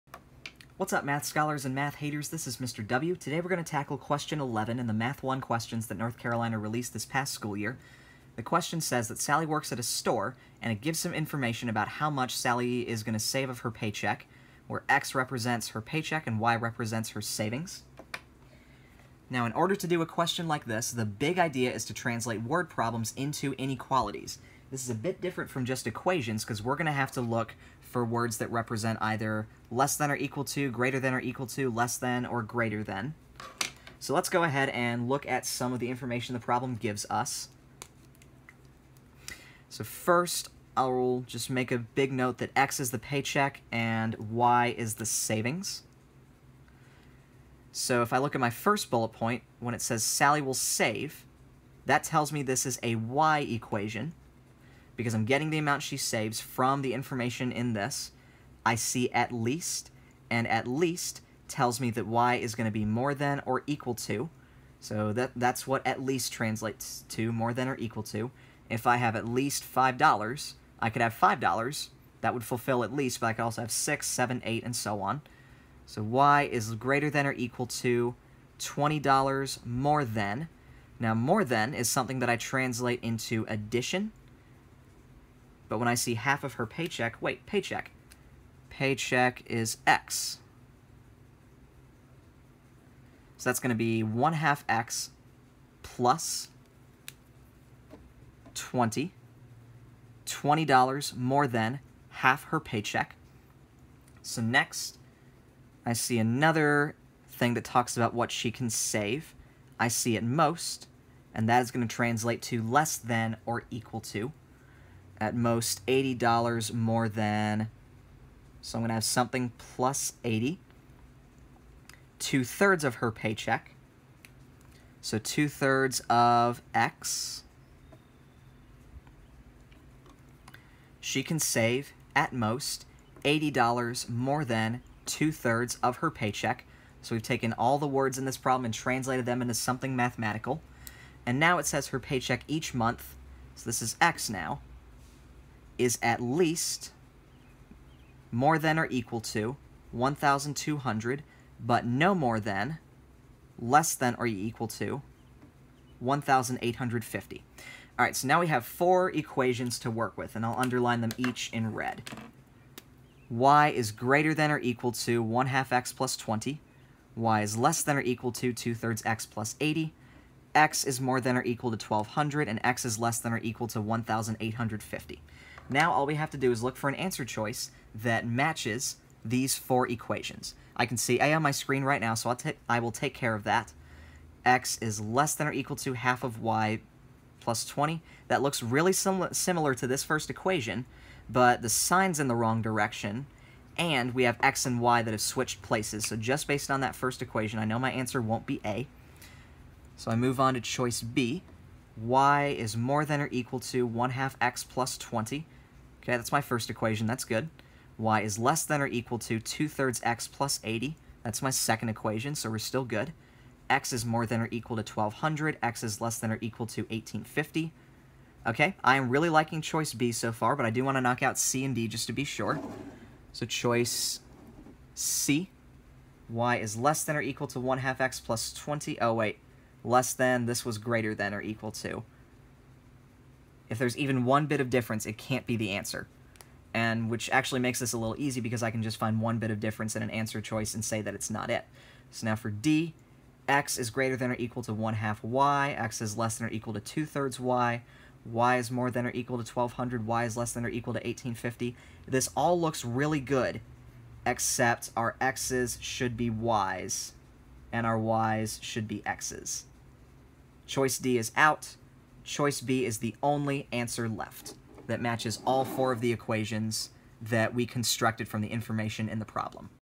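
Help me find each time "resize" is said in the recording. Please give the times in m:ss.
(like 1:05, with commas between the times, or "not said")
not said.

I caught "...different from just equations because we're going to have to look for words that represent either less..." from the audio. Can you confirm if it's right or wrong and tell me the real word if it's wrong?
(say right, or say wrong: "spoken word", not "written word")
right.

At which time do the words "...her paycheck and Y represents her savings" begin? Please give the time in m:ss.
0:15.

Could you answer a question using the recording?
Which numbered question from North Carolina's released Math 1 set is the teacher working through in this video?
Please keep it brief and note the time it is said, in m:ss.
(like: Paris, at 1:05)
11, at 0:03.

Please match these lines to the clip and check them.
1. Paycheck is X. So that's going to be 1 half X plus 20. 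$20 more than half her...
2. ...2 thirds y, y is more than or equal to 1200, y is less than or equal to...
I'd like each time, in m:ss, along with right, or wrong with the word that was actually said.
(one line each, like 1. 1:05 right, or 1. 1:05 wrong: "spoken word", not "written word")
1. 1:28 right
2. 4:06 right.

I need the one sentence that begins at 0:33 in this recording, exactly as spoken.
So let's go ahead and look at some of the information the problem gives us.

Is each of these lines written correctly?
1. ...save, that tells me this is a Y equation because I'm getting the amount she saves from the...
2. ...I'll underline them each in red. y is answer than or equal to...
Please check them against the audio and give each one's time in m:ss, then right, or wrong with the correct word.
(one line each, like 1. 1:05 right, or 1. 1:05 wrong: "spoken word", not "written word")
1. 0:50 right
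2. 2:40 wrong: "greater", not "answer".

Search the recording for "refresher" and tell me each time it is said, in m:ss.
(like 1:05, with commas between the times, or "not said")
not said.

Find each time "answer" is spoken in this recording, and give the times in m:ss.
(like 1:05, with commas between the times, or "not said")
2:56, 3:17, 3:55, 4:00, 4:23.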